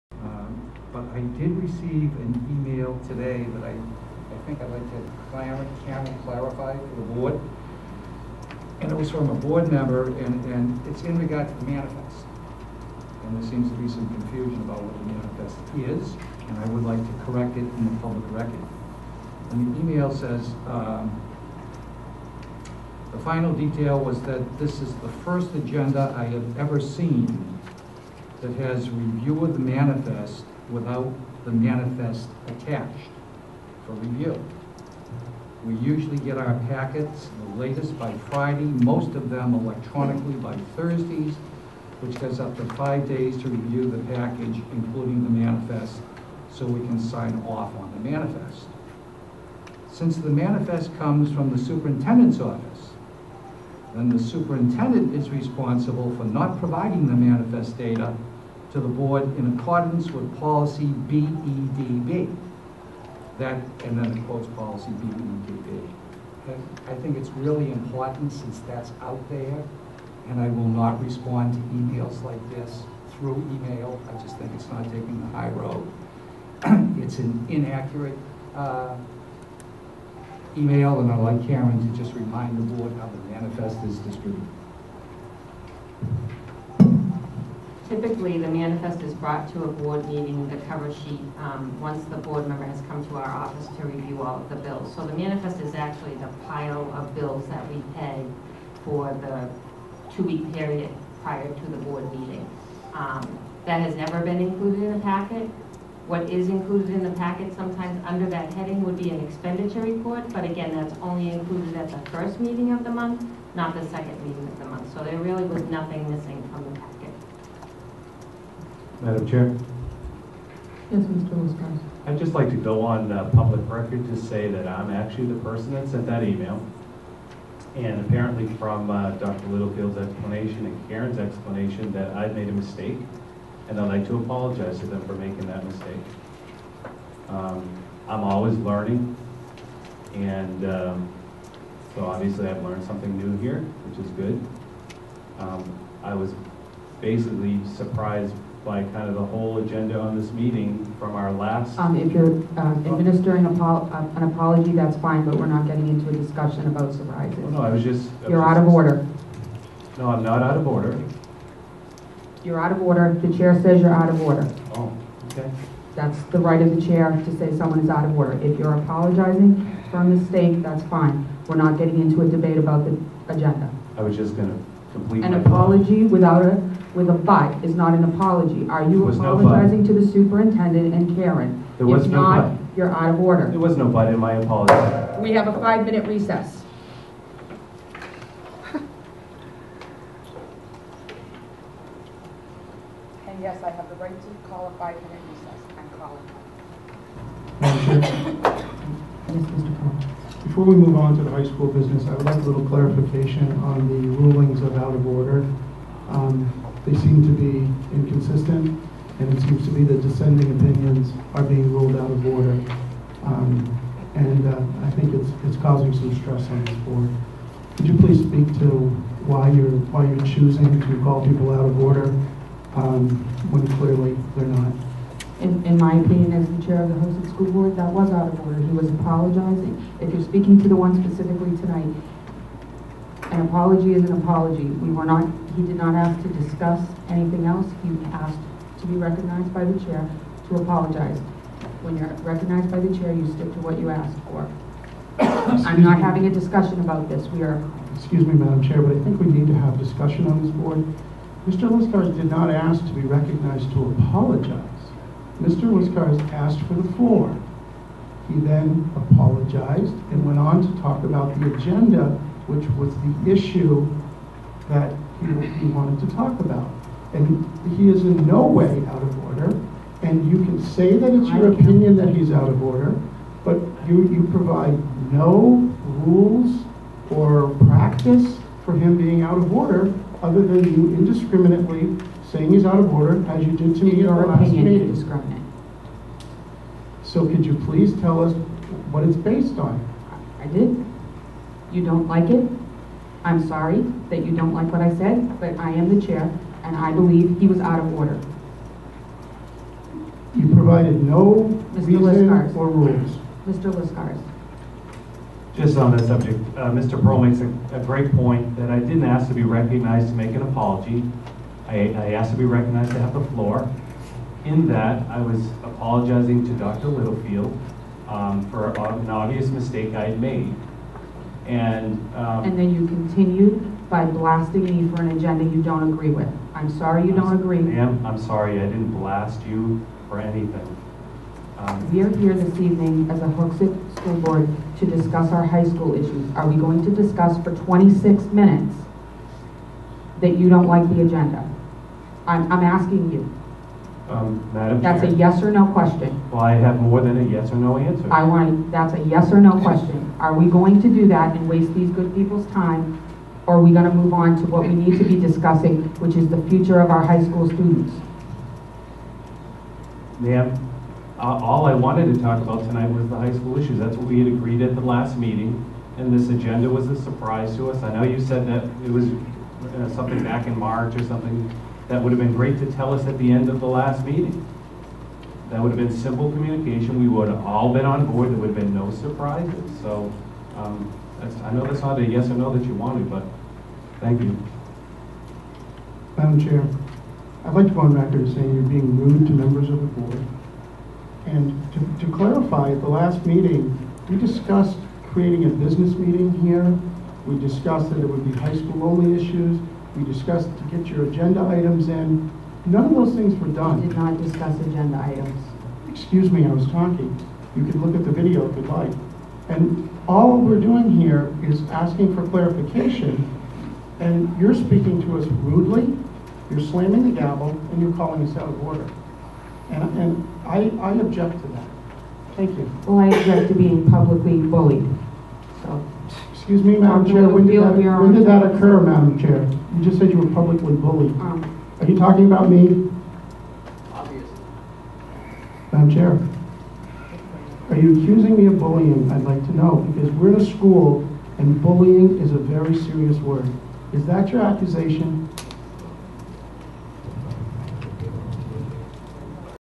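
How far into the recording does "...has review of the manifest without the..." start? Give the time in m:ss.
0:28.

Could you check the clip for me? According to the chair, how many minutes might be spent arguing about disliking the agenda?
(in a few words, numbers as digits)
26.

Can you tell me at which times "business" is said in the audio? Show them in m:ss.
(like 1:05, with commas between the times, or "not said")
3:21, 6:35.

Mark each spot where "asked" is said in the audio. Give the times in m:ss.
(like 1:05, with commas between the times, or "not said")
3:58, 4:03, 4:16, 5:12.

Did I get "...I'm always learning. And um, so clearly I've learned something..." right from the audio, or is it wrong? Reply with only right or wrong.
wrong.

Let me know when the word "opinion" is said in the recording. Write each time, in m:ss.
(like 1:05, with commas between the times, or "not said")
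3:30, 3:45, 4:31.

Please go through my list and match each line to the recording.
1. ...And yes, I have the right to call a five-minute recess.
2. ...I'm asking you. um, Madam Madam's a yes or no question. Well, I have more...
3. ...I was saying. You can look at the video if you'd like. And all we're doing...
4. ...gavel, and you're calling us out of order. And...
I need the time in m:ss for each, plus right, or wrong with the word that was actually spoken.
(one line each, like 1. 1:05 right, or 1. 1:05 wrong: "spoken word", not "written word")
1. 3:13 right
2. 5:42 wrong: "That", not "Madam"
3. 6:46 wrong: "talking", not "saying"
4. 6:57 right.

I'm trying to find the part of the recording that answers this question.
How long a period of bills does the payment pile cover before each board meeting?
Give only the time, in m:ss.
1:40.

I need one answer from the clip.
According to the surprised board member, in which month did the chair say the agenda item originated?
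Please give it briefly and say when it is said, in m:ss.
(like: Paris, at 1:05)
March, at 6:10.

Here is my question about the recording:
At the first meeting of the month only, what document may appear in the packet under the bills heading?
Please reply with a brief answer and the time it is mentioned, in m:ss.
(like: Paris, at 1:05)
expenditure report, at 1:49.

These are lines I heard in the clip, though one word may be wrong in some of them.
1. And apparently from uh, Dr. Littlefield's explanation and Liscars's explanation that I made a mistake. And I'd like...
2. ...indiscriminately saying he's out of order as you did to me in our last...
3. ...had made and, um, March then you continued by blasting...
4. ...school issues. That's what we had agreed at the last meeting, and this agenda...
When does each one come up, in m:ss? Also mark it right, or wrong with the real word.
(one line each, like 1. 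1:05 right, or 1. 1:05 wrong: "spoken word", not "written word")
1. 2:07 wrong: "Karen", not "Liscars"
2. 4:40 right
3. 5:20 wrong: "And", not "March"
4. 6:03 right.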